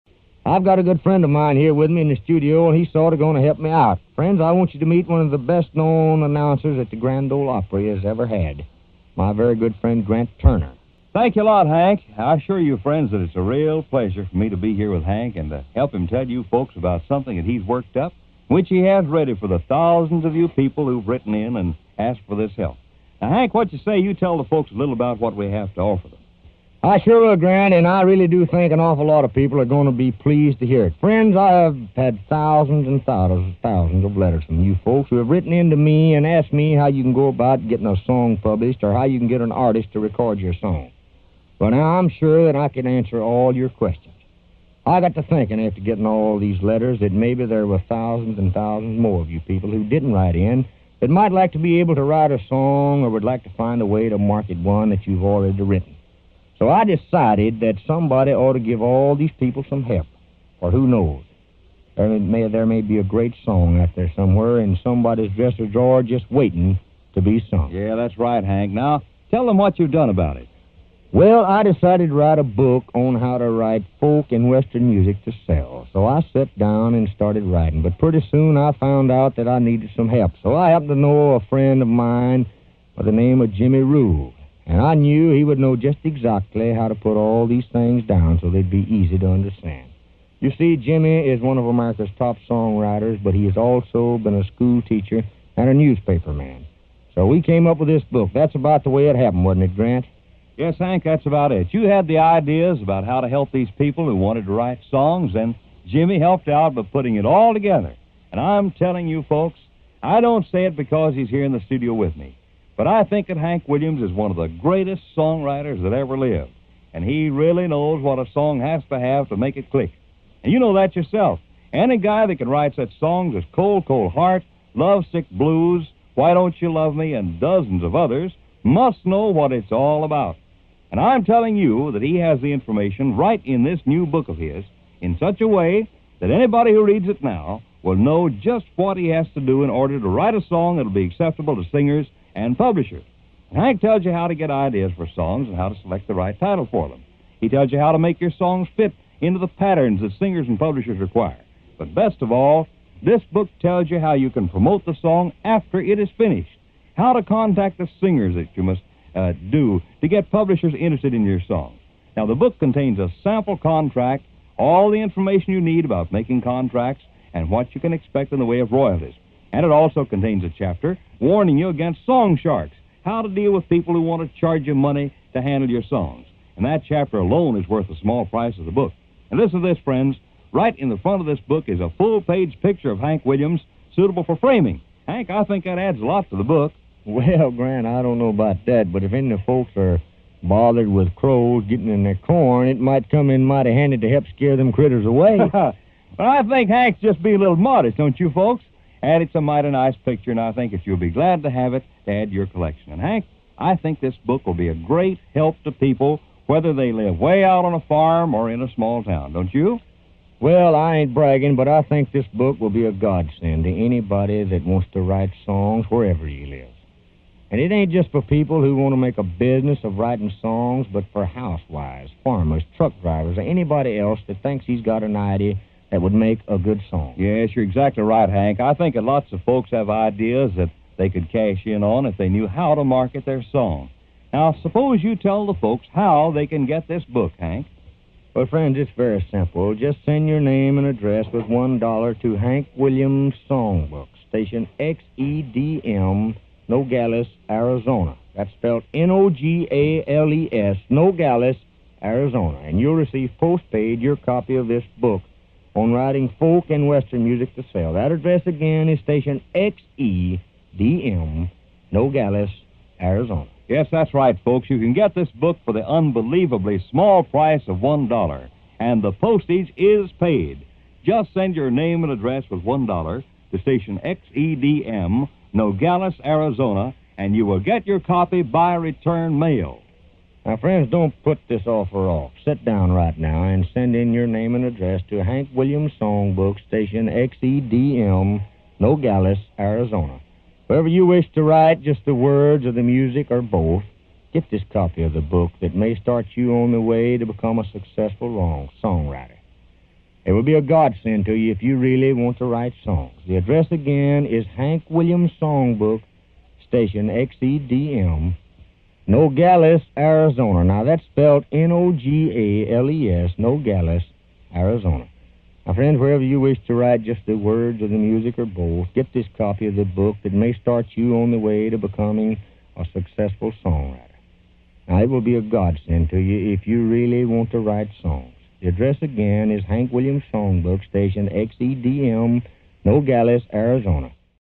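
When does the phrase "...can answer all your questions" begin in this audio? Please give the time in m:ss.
0:42.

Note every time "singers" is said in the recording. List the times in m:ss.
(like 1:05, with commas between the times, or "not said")
2:21, 2:30, 2:37.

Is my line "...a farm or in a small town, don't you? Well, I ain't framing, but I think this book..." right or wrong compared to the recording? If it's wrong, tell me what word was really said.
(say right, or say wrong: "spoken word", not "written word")
wrong: "bragging", not "framing".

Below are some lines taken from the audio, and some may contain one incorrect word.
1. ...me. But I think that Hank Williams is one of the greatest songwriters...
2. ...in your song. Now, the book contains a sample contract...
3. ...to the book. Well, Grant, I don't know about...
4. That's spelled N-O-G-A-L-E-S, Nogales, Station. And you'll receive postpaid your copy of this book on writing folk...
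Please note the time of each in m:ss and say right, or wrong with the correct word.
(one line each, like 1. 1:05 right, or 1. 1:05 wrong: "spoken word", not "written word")
1. 1:52 right
2. 2:41 right
3. 3:06 right
4. 4:08 wrong: "Arizona", not "Station".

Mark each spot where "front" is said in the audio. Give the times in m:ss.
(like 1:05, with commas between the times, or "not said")
3:00.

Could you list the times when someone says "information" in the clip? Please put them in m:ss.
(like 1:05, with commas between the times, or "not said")
2:12, 2:45.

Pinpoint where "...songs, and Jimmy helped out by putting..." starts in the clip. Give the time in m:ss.
1:44.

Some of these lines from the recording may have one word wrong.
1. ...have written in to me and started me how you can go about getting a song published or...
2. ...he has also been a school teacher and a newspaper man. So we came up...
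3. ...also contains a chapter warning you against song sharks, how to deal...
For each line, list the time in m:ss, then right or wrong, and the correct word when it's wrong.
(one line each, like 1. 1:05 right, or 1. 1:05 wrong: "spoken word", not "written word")
1. 0:35 wrong: "asked", not "started"
2. 1:33 right
3. 2:49 right.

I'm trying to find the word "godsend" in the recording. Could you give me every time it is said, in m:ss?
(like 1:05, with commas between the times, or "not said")
3:32, 5:00, 5:25.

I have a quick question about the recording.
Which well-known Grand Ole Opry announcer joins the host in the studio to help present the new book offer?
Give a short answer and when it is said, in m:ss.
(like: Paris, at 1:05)
Grant Turner, at 0:10.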